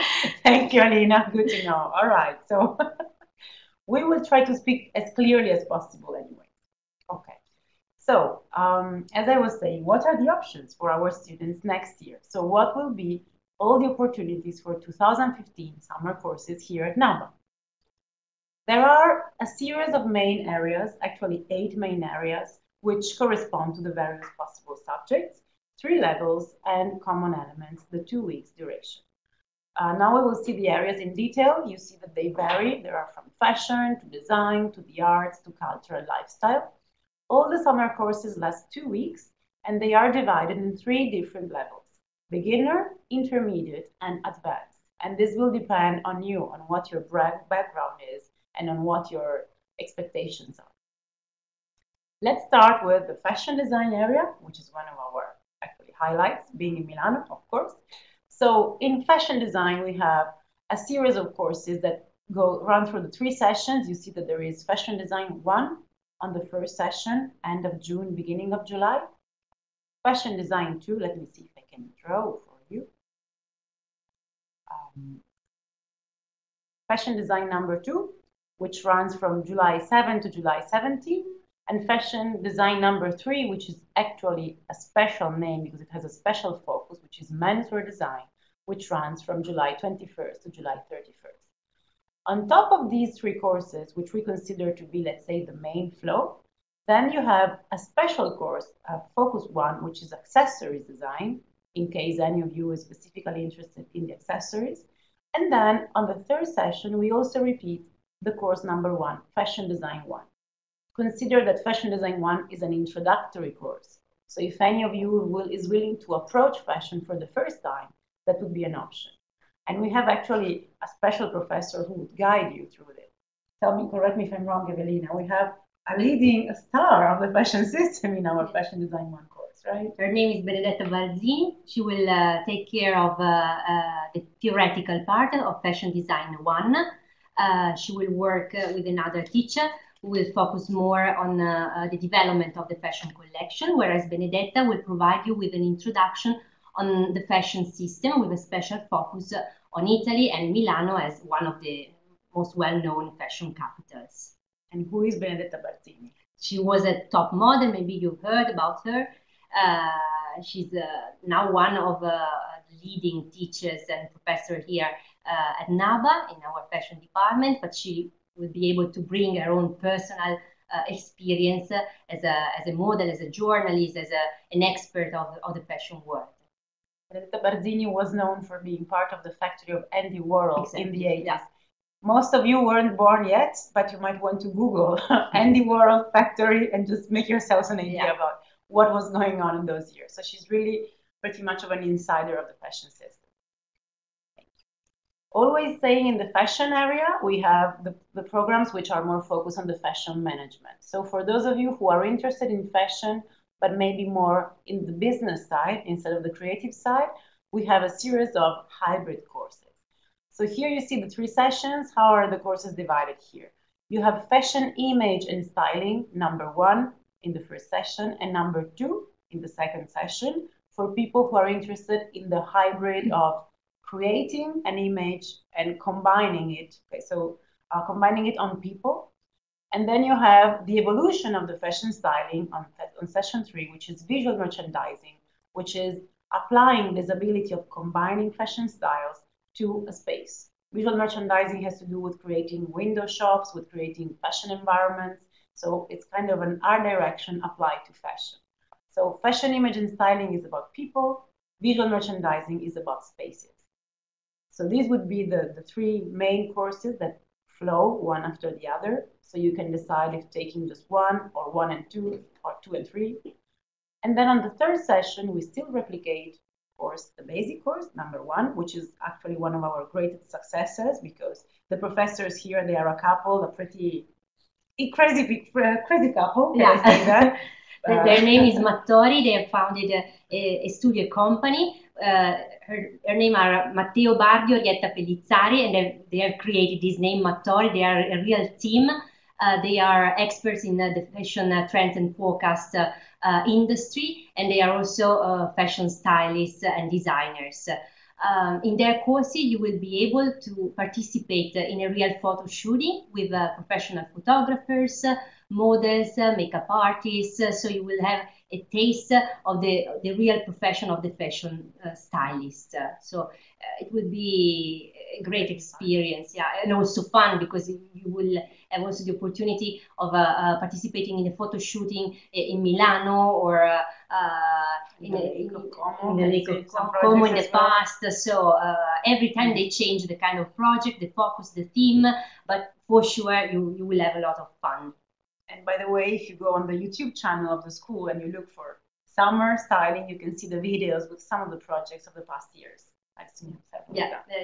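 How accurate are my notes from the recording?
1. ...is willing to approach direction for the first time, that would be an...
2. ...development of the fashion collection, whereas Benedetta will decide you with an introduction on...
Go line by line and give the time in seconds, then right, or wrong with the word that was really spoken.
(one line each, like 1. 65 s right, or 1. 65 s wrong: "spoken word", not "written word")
1. 115 s wrong: "fashion", not "direction"
2. 141 s wrong: "provide", not "decide".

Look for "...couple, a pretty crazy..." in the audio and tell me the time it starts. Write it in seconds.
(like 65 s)
272 s.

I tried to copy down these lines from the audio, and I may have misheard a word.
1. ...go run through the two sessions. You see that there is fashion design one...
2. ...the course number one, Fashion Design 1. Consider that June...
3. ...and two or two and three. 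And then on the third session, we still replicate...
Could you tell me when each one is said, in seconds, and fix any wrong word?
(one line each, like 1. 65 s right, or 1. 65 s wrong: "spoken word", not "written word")
1. 62 s wrong: "three", not "two"
2. 108 s wrong: "Fashion", not "June"
3. 261 s right.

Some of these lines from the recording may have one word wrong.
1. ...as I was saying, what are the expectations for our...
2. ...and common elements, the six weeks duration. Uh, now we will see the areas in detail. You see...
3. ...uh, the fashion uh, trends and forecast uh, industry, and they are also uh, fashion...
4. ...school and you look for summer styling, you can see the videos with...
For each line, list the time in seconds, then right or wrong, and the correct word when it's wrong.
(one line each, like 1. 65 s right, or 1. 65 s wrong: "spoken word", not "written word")
1. 9 s wrong: "options", not "expectations"
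2. 26 s wrong: "two", not "six"
3. 290 s right
4. 337 s right.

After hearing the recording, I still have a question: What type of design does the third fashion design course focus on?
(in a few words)
Menswear design.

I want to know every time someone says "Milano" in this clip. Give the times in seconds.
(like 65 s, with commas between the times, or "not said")
56 s, 150 s, 322 s.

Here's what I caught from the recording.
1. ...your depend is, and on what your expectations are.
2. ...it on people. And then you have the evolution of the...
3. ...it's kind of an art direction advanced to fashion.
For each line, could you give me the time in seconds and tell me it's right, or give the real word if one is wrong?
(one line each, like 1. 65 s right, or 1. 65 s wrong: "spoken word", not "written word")
1. 46 s wrong: "background", not "depend"
2. 228 s right
3. 245 s wrong: "applied", not "advanced".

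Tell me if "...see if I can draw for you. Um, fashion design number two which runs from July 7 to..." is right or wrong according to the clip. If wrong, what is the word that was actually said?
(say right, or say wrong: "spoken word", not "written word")
right.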